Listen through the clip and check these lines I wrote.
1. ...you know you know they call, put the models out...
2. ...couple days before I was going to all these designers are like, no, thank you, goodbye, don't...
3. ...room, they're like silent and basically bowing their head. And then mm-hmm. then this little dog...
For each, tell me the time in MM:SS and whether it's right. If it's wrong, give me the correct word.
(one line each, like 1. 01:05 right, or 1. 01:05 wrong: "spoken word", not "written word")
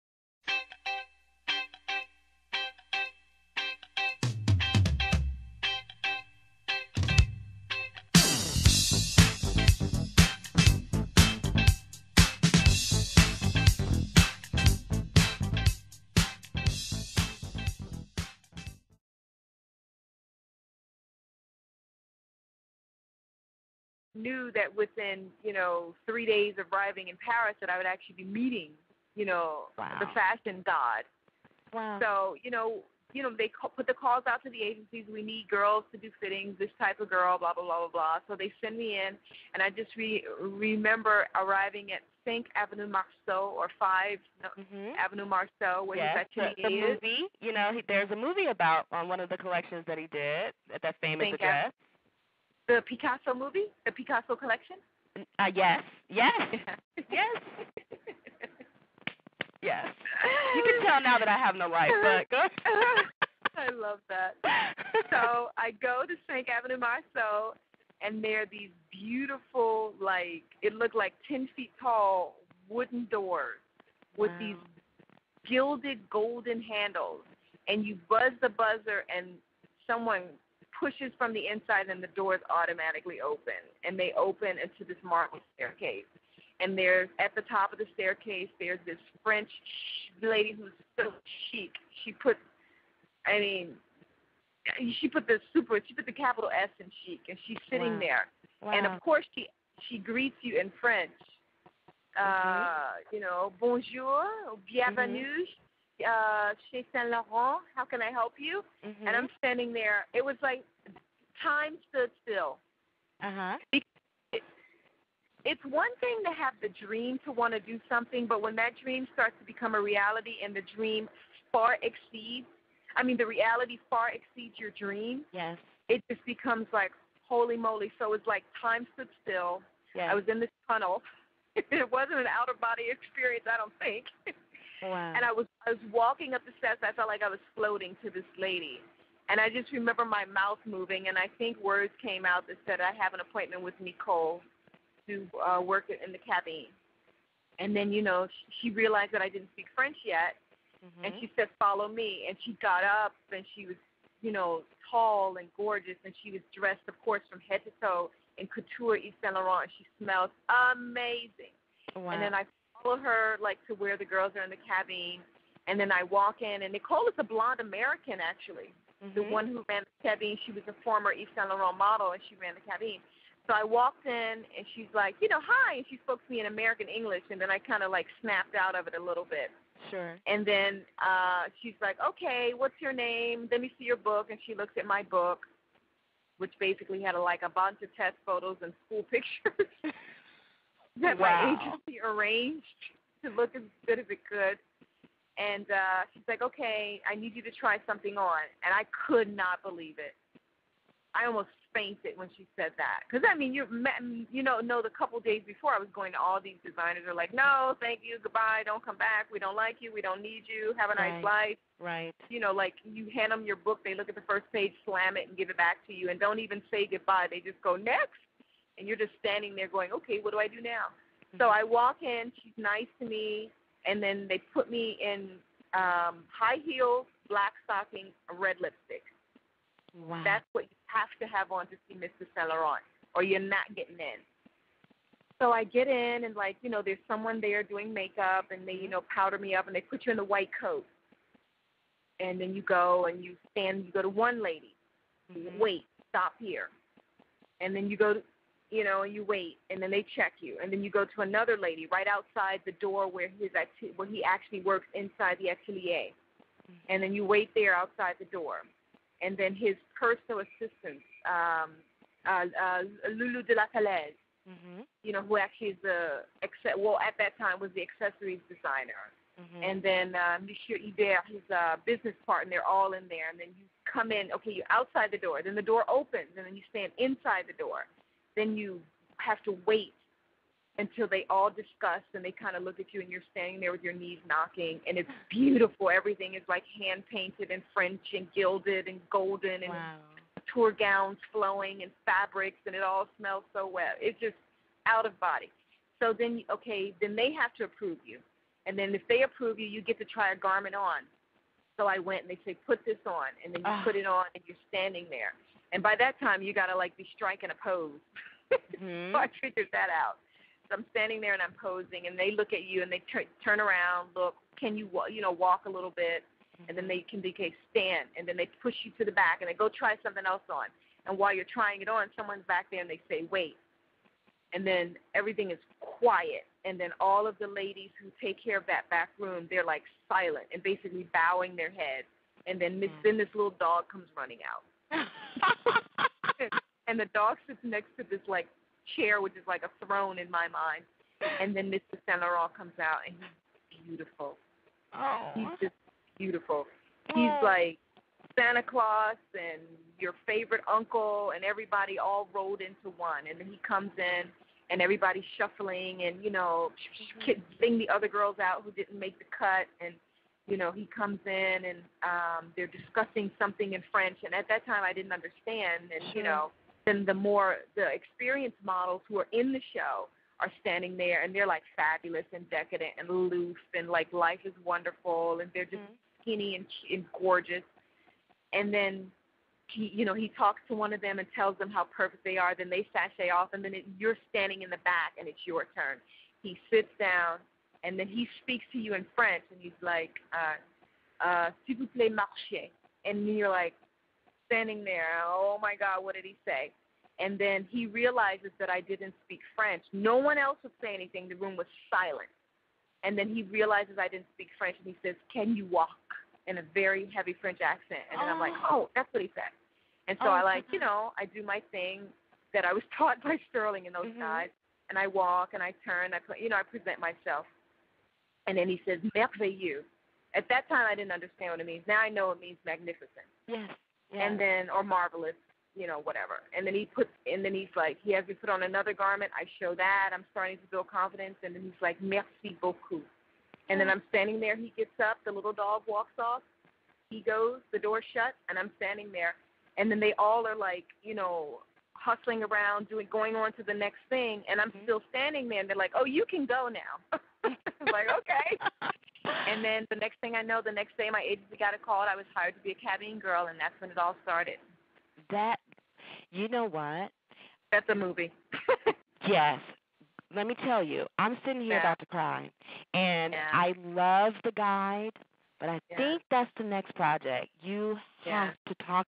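1. 00:32 wrong: "calls", not "models"
2. 03:24 right
3. 05:29 right.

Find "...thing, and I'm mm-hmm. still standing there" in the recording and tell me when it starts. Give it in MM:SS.
07:24.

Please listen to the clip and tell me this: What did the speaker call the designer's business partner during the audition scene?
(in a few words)
Monsieur Hubert.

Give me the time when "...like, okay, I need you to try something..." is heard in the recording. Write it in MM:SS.
03:16.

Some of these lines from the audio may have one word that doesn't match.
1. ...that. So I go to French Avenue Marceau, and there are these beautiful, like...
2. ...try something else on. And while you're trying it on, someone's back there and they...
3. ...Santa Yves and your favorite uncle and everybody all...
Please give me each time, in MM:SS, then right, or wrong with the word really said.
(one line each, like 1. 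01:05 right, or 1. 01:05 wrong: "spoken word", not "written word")
1. 01:04 wrong: "Cinq", not "French"
2. 05:19 right
3. 05:48 wrong: "Claus", not "Yves".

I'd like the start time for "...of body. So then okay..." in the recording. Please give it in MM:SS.
04:55.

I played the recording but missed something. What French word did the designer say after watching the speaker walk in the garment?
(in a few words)
Merveilleux.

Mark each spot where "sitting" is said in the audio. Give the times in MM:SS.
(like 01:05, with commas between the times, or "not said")
01:37, 07:41.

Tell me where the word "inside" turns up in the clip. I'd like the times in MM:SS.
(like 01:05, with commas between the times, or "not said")
01:21, 04:14, 04:36.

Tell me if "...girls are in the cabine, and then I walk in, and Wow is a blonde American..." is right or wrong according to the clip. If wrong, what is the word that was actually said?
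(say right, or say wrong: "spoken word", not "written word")
wrong: "Nicole", not "Wow".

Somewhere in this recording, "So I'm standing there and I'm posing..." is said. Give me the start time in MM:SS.
05:10.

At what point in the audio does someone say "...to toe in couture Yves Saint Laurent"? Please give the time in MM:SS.
02:37.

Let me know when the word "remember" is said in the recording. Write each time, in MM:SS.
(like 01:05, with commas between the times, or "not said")
00:40, 02:19.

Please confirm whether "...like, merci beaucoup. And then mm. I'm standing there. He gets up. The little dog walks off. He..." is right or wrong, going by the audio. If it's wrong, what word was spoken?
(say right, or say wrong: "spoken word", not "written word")
right.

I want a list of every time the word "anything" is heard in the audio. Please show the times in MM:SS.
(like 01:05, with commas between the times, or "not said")
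06:40.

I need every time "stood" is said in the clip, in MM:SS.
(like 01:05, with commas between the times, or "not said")
01:51, 02:08.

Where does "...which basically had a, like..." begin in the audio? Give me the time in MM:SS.
03:06.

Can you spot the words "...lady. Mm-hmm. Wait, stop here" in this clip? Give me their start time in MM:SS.
04:04.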